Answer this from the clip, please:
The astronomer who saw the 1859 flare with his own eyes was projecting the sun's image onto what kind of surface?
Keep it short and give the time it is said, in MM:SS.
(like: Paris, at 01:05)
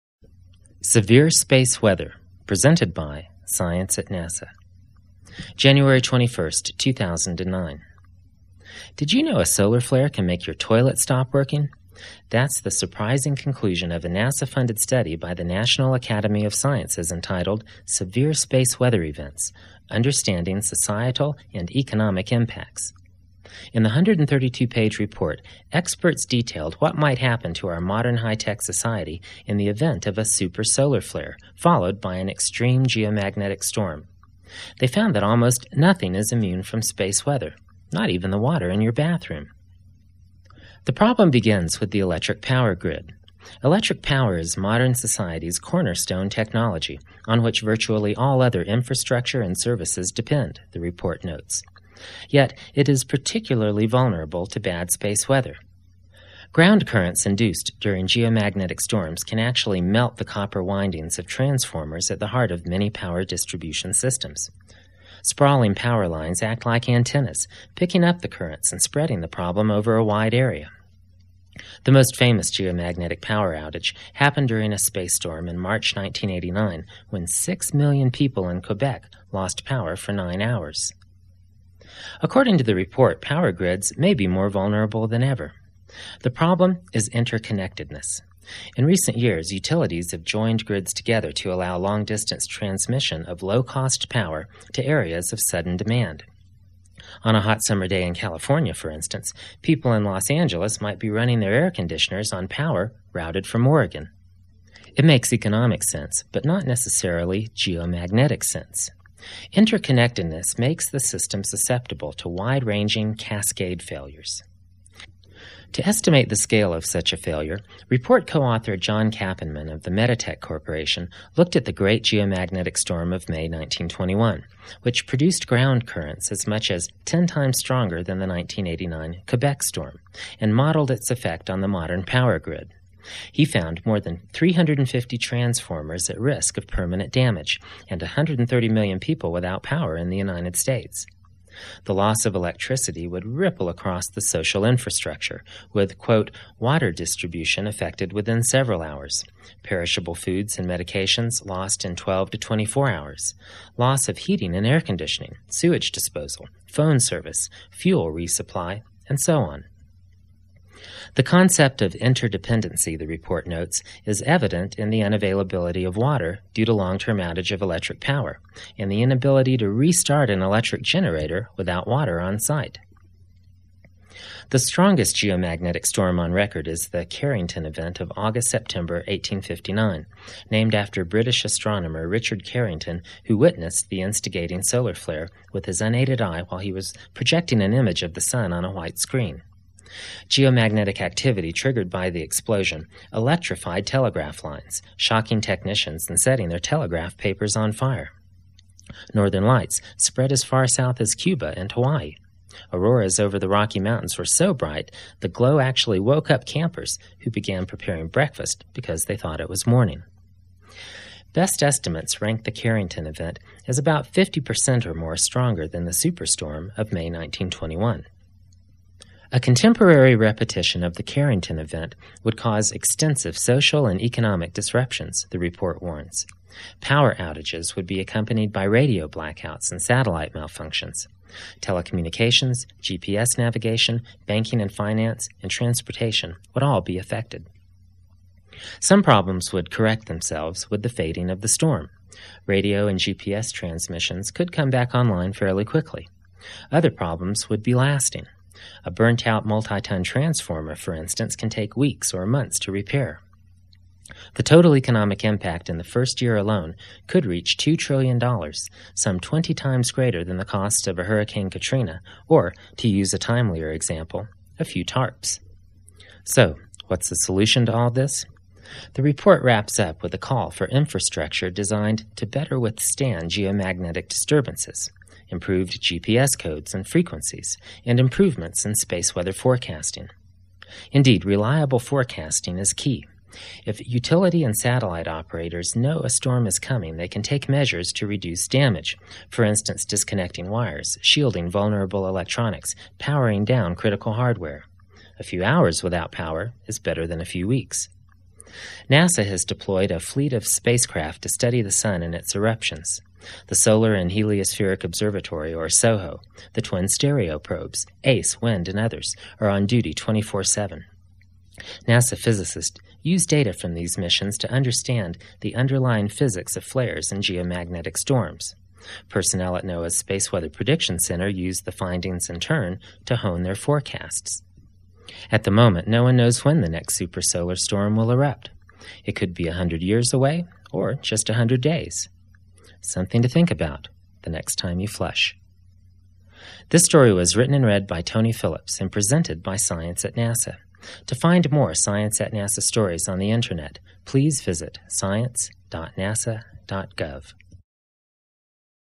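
white screen, at 03:08.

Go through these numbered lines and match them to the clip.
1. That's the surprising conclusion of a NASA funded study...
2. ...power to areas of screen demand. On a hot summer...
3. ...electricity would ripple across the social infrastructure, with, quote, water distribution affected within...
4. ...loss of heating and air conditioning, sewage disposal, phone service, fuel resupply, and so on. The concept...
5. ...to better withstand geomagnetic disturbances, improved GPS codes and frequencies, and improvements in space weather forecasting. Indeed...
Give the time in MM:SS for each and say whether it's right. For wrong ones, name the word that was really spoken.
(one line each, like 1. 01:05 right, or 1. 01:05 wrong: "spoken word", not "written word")
1. 00:12 right
2. 01:34 wrong: "sudden", not "screen"
3. 02:22 right
4. 02:33 right
5. 04:32 right.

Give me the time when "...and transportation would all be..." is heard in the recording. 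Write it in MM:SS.
03:55.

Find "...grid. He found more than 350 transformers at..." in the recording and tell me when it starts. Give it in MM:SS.
02:12.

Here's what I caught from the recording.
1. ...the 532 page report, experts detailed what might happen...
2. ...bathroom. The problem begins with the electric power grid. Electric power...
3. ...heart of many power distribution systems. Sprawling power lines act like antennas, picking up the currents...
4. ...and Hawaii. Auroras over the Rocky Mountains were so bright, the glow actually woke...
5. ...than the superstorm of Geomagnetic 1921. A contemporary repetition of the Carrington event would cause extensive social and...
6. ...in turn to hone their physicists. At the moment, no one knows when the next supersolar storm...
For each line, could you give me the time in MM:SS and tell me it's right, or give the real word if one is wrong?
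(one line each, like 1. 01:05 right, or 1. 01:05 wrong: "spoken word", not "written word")
1. 00:23 wrong: "132", not "532"
2. 00:38 right
3. 01:02 right
4. 03:21 right
5. 03:35 wrong: "May", not "Geomagnetic"
6. 05:22 wrong: "forecasts", not "physicists".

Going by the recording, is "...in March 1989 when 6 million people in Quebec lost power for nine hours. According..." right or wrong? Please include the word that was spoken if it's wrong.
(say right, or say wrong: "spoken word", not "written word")
right.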